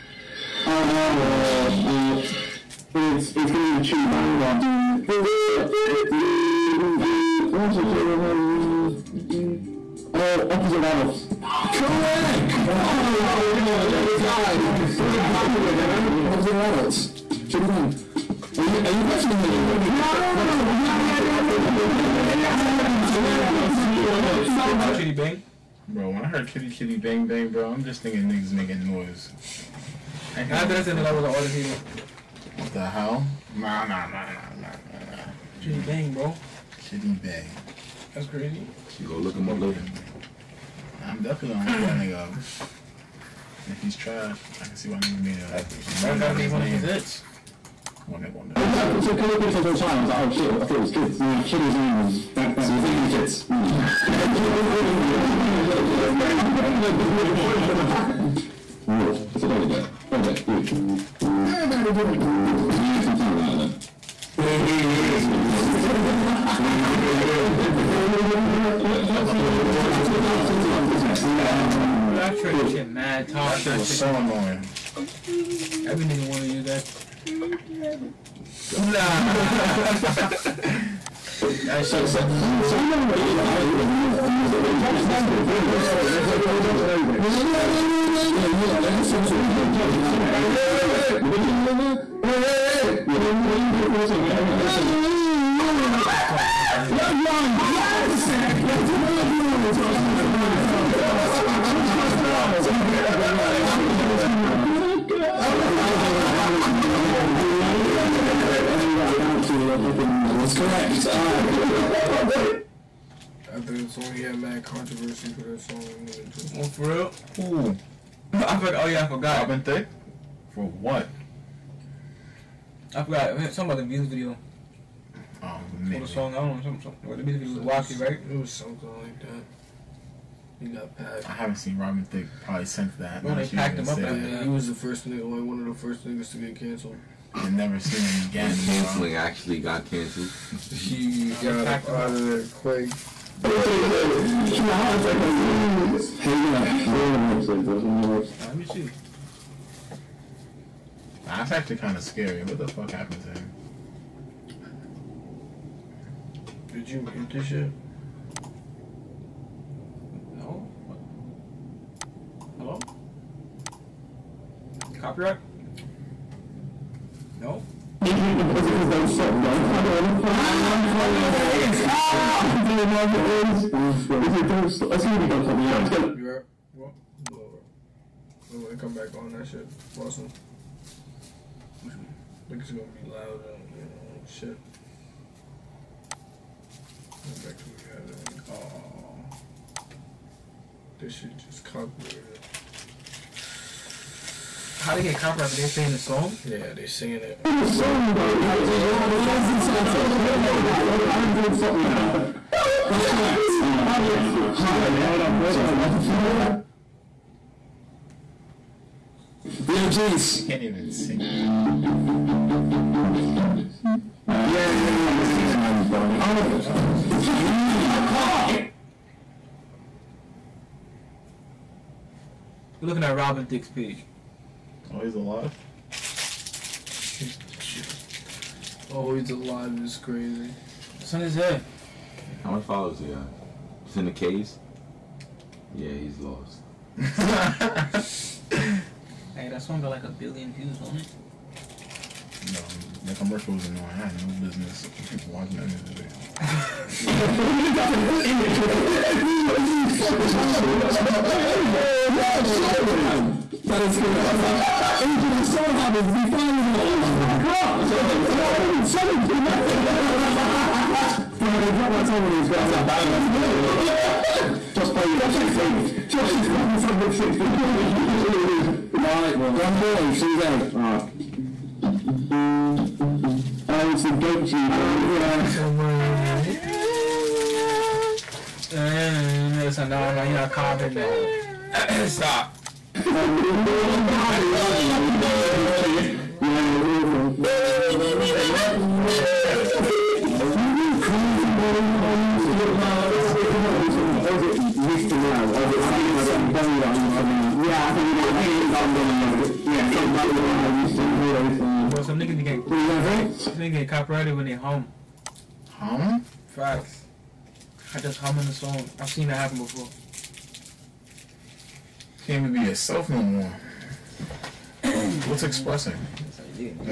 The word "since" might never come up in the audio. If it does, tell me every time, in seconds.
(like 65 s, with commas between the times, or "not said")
132 s.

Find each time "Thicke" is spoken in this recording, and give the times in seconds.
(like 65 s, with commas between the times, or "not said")
119 s, 132 s, 223 s.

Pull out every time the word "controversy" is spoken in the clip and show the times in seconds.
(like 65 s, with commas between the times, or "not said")
114 s.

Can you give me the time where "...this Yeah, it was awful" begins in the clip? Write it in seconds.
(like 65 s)
285 s.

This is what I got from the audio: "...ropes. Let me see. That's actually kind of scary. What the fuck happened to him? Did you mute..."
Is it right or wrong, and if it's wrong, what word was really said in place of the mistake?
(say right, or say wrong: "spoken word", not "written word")
right.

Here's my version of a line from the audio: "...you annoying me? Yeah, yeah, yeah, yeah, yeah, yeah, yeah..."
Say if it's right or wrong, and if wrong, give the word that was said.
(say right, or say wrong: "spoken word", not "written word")
wrong: "questioning", not "annoying".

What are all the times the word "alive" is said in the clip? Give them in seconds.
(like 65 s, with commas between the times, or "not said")
225 s, 229 s.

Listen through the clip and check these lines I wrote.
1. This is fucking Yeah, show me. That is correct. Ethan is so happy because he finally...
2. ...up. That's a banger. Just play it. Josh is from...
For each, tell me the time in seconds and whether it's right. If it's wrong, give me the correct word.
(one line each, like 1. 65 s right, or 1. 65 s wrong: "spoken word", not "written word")
1. 250 s right
2. 262 s right.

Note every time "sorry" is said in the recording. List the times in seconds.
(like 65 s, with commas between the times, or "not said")
205 s, 257 s, 291 s.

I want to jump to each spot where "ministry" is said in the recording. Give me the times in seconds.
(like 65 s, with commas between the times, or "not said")
not said.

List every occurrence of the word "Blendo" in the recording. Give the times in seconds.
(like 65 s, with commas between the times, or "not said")
93 s.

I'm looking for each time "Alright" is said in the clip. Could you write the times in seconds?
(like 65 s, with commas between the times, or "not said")
111 s, 269 s.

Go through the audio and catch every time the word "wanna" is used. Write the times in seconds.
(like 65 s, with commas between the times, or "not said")
76 s.